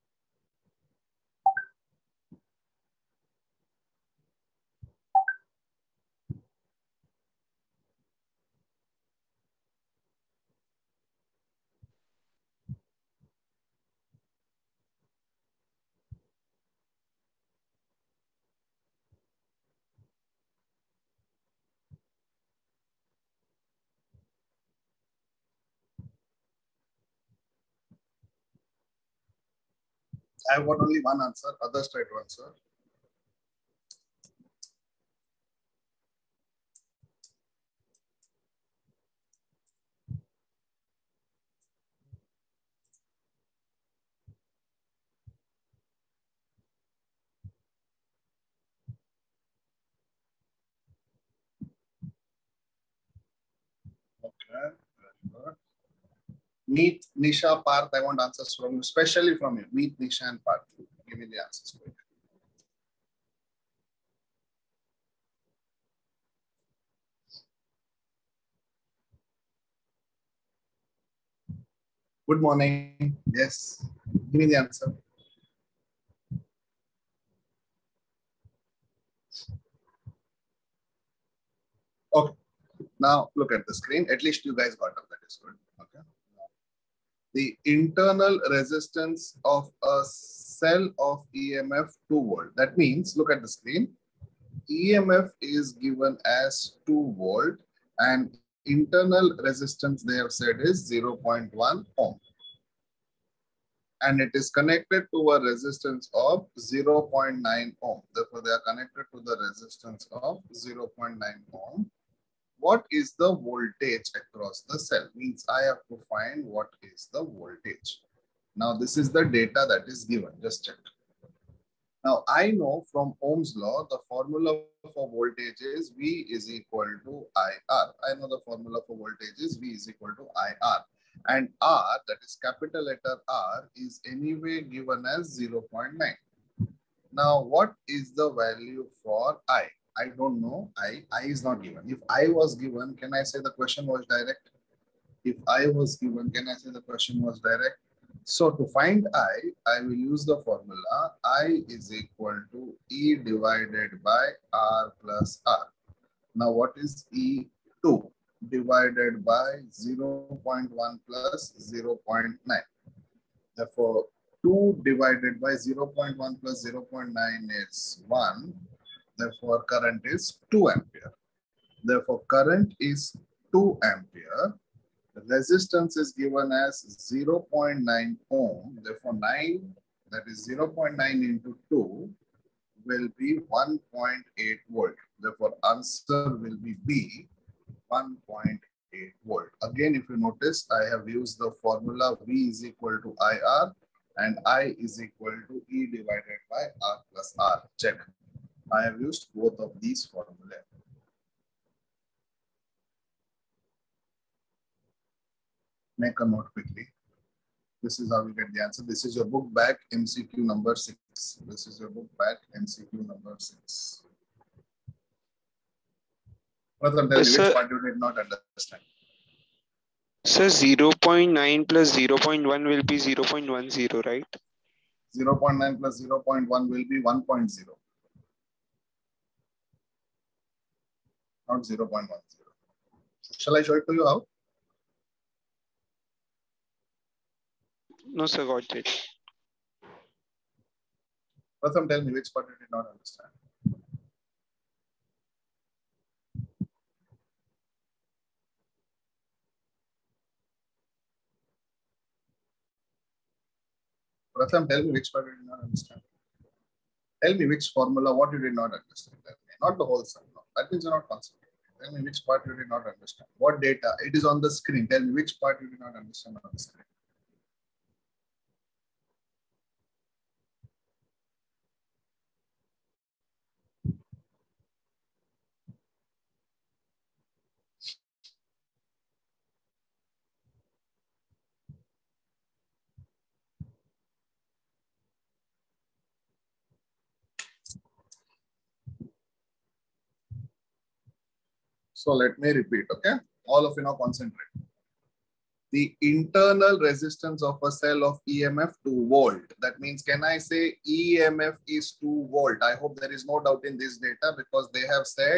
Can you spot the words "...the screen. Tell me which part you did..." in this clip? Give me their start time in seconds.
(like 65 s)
264 s.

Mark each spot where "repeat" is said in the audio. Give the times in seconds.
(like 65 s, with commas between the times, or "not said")
292 s.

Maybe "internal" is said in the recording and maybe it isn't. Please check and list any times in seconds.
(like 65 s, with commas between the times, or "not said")
87 s, 98 s, 296 s.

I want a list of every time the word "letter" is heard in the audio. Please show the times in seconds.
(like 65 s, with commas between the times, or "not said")
132 s.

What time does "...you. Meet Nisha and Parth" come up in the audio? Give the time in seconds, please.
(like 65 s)
59 s.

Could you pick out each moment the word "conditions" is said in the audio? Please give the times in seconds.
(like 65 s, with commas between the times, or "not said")
not said.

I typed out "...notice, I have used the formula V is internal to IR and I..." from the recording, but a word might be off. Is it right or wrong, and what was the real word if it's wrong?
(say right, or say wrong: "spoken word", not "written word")
wrong: "equal", not "internal".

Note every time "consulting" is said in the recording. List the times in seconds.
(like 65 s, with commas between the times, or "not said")
261 s.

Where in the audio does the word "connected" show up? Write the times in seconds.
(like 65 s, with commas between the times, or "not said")
104 s, 108 s.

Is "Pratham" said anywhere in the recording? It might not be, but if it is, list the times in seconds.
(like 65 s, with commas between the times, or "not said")
241 s, 254 s.